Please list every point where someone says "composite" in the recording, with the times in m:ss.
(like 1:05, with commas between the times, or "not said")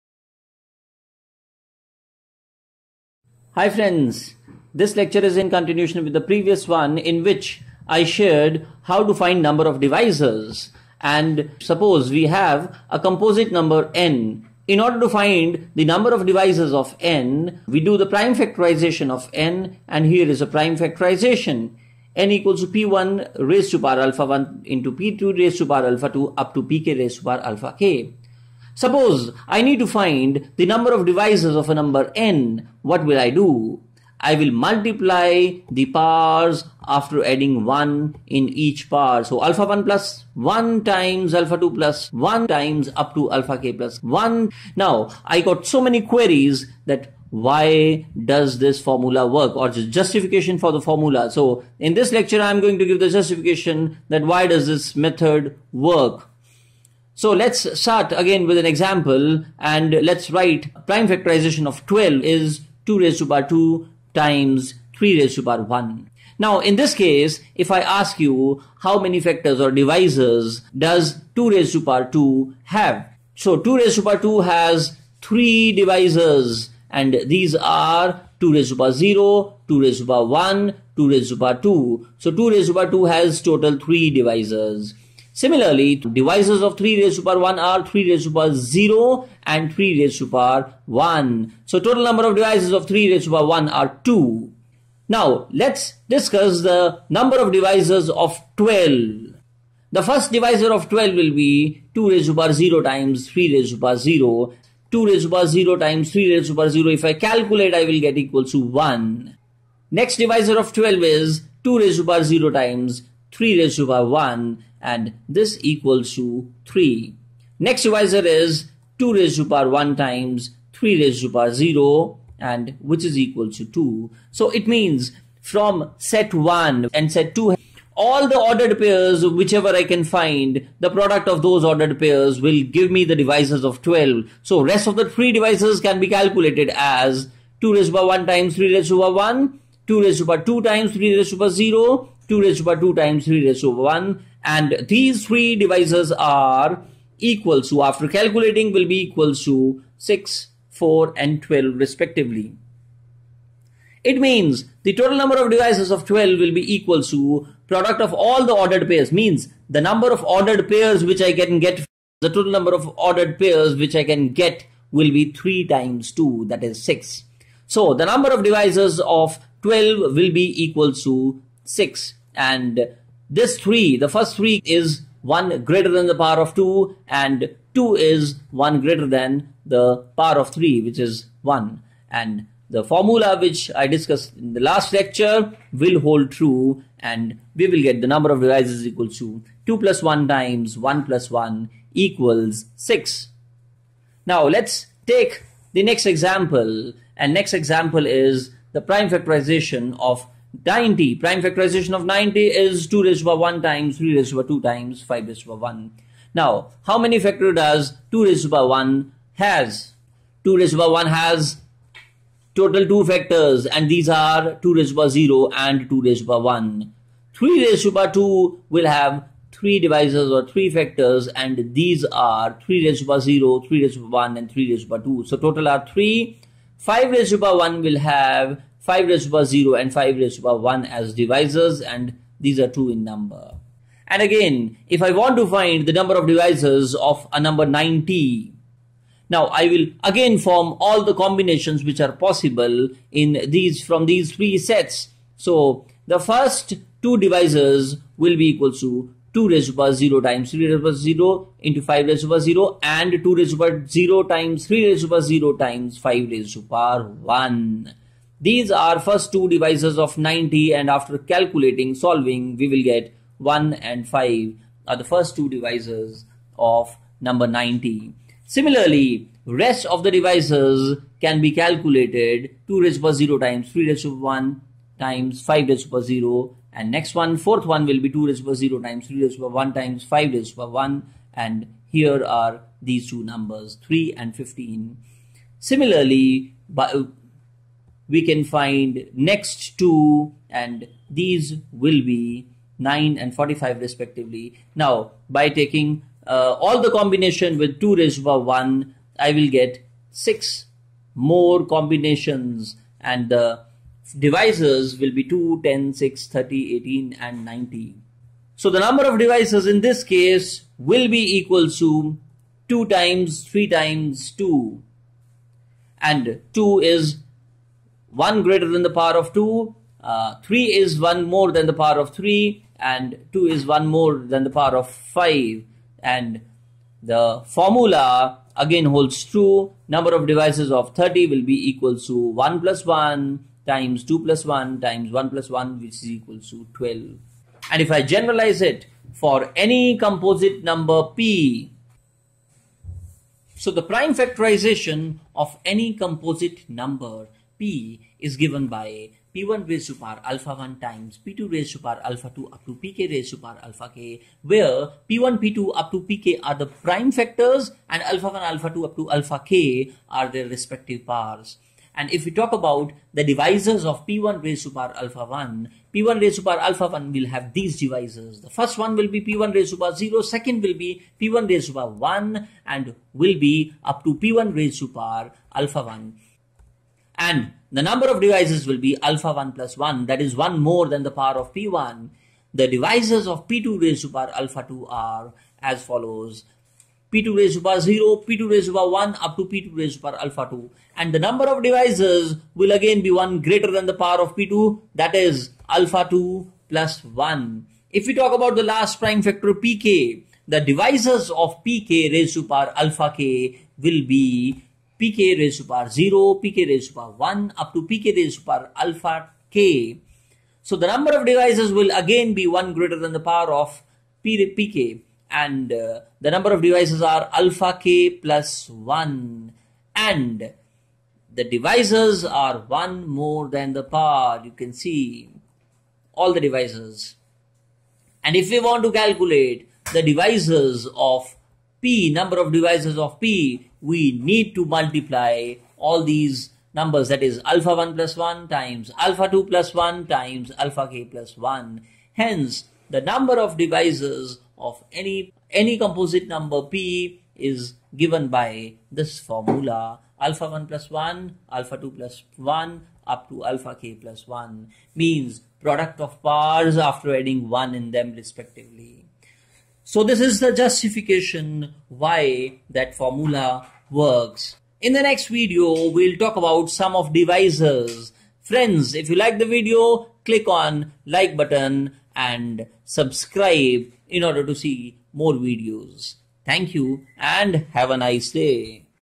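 0:12, 5:39, 5:45, 7:25.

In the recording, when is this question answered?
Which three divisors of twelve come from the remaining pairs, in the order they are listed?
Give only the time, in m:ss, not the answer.
2:30.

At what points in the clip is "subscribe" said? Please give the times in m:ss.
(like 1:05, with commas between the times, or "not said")
7:52.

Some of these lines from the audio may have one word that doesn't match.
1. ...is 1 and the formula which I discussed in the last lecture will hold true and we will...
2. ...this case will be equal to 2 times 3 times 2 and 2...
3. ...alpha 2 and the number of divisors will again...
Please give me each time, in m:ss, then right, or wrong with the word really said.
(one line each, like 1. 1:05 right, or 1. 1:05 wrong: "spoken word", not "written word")
1. 3:00 right
2. 5:09 right
3. 6:30 right.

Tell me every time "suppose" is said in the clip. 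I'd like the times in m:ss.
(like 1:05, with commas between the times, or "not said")
0:11, 0:28.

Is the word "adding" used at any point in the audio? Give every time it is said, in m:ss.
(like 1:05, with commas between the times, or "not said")
0:37, 7:37.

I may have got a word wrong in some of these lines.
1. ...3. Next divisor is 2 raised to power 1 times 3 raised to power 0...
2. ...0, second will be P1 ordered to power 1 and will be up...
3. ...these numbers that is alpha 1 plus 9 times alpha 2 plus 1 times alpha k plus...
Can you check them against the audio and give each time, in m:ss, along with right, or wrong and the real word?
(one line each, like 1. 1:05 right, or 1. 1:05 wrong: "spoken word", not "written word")
1. 1:56 right
2. 6:09 wrong: "raised", not "ordered"
3. 7:16 wrong: "1", not "9".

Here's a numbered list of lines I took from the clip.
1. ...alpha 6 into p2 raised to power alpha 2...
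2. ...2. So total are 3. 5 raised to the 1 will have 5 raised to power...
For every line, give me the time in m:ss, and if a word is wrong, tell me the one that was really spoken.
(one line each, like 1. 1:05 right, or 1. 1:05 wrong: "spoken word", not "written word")
1. 0:23 wrong: "1", not "6"
2. 3:45 right.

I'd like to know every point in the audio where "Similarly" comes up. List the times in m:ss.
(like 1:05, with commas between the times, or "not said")
1:25, 4:28, 4:45.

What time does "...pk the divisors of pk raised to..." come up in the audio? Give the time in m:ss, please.
6:39.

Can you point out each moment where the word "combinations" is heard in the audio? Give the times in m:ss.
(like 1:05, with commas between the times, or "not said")
4:01, 4:56, 5:01.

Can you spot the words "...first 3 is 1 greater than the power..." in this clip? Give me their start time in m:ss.
2:54.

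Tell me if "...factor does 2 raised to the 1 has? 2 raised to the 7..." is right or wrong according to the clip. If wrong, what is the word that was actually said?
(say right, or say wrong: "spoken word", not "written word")
wrong: "1", not "7".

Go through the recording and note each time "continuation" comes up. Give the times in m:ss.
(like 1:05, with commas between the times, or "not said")
0:05.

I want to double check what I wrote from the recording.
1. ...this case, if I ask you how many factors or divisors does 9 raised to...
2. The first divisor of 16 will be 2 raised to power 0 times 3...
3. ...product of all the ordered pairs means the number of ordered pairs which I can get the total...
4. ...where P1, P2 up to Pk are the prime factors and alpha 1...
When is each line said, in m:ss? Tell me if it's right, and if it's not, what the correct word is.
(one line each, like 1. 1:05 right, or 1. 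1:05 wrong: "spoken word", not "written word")
1. 1:06 wrong: "2", not "9"
2. 1:39 wrong: "12", not "16"
3. 2:37 right
4. 5:54 right.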